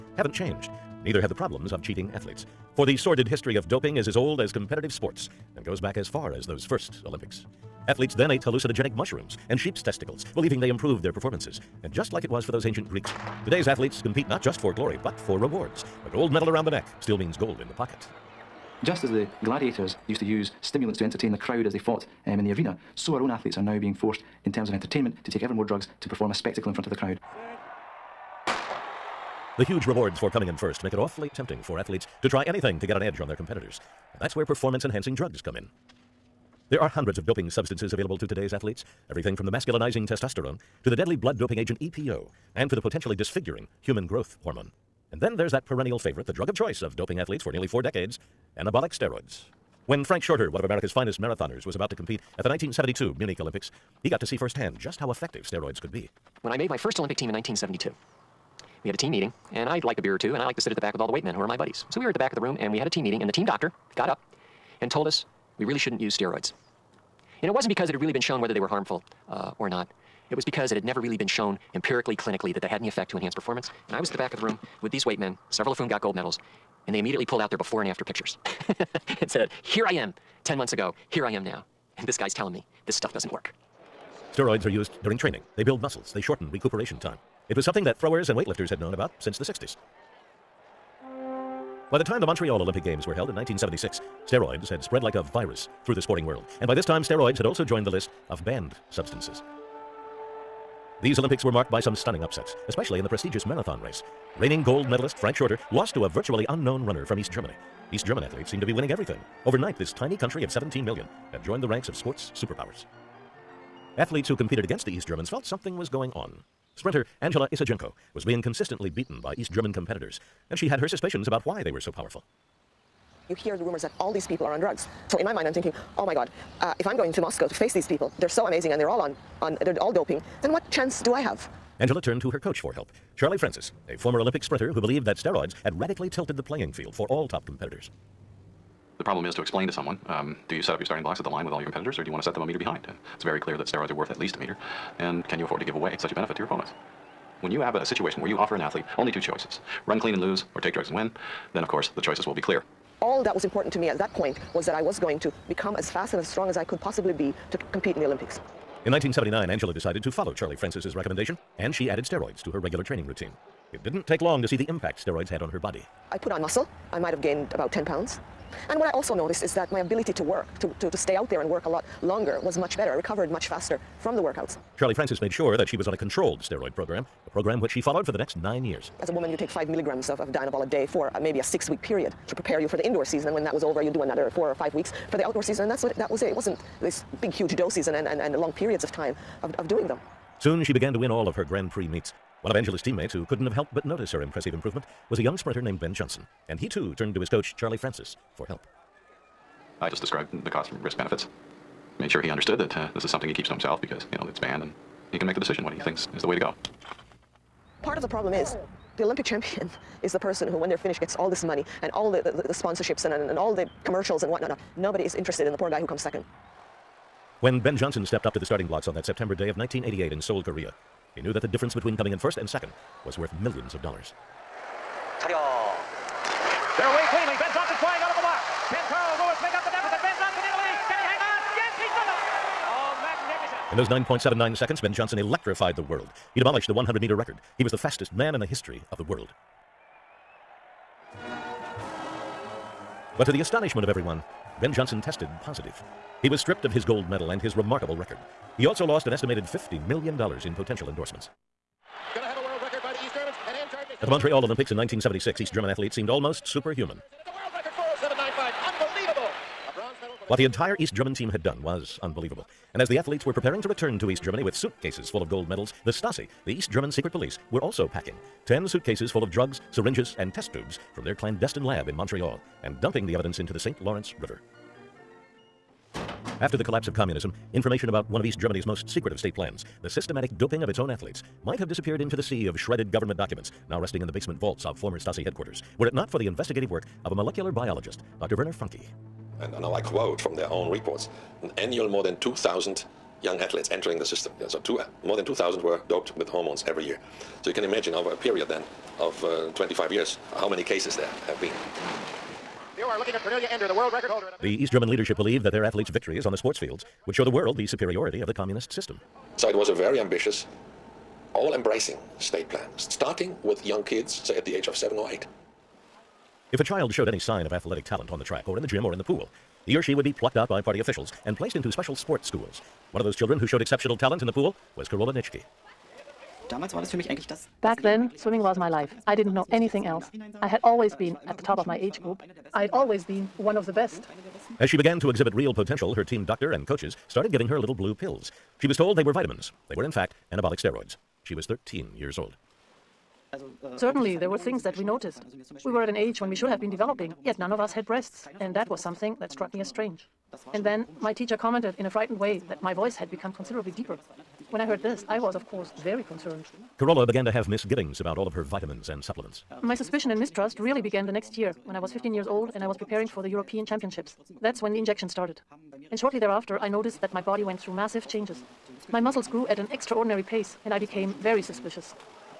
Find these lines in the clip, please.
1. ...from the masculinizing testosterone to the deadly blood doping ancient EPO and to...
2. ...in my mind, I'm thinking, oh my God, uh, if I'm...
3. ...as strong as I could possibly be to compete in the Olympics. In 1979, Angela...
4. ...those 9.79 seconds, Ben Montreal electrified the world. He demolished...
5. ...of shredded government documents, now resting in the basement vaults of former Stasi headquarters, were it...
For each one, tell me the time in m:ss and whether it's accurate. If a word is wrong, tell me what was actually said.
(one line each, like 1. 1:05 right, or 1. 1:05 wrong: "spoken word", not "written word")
1. 0:39 wrong: "agent", not "ancient"
2. 2:05 right
3. 2:36 right
4. 3:53 wrong: "Johnson", not "Montreal"
5. 4:42 right.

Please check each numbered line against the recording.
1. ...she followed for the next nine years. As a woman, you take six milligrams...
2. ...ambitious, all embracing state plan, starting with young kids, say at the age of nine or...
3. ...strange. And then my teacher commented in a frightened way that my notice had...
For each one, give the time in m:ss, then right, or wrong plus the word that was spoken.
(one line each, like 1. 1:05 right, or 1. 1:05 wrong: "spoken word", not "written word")
1. 2:57 wrong: "five", not "six"
2. 5:09 wrong: "seven", not "nine"
3. 5:49 wrong: "voice", not "notice".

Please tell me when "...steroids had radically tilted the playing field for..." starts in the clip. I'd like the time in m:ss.
2:15.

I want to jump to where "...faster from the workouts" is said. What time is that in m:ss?
2:53.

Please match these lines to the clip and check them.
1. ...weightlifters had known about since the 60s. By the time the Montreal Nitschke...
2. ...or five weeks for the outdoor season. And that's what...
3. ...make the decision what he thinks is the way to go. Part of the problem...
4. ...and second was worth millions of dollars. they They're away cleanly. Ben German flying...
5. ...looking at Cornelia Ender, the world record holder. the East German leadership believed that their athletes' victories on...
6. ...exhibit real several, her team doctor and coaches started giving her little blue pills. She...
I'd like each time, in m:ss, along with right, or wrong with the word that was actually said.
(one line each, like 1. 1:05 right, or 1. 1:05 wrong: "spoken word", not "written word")
1. 1:28 wrong: "Olympic", not "Nitschke"
2. 3:04 right
3. 3:25 right
4. 3:42 wrong: "Johnson", not "German"
5. 5:02 right
6. 5:35 wrong: "potential", not "several".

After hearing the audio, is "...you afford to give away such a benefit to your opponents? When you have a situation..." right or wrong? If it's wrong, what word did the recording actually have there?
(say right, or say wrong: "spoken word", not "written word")
right.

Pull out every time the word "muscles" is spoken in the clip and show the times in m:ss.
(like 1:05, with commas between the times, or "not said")
1:25, 2:46, 6:08.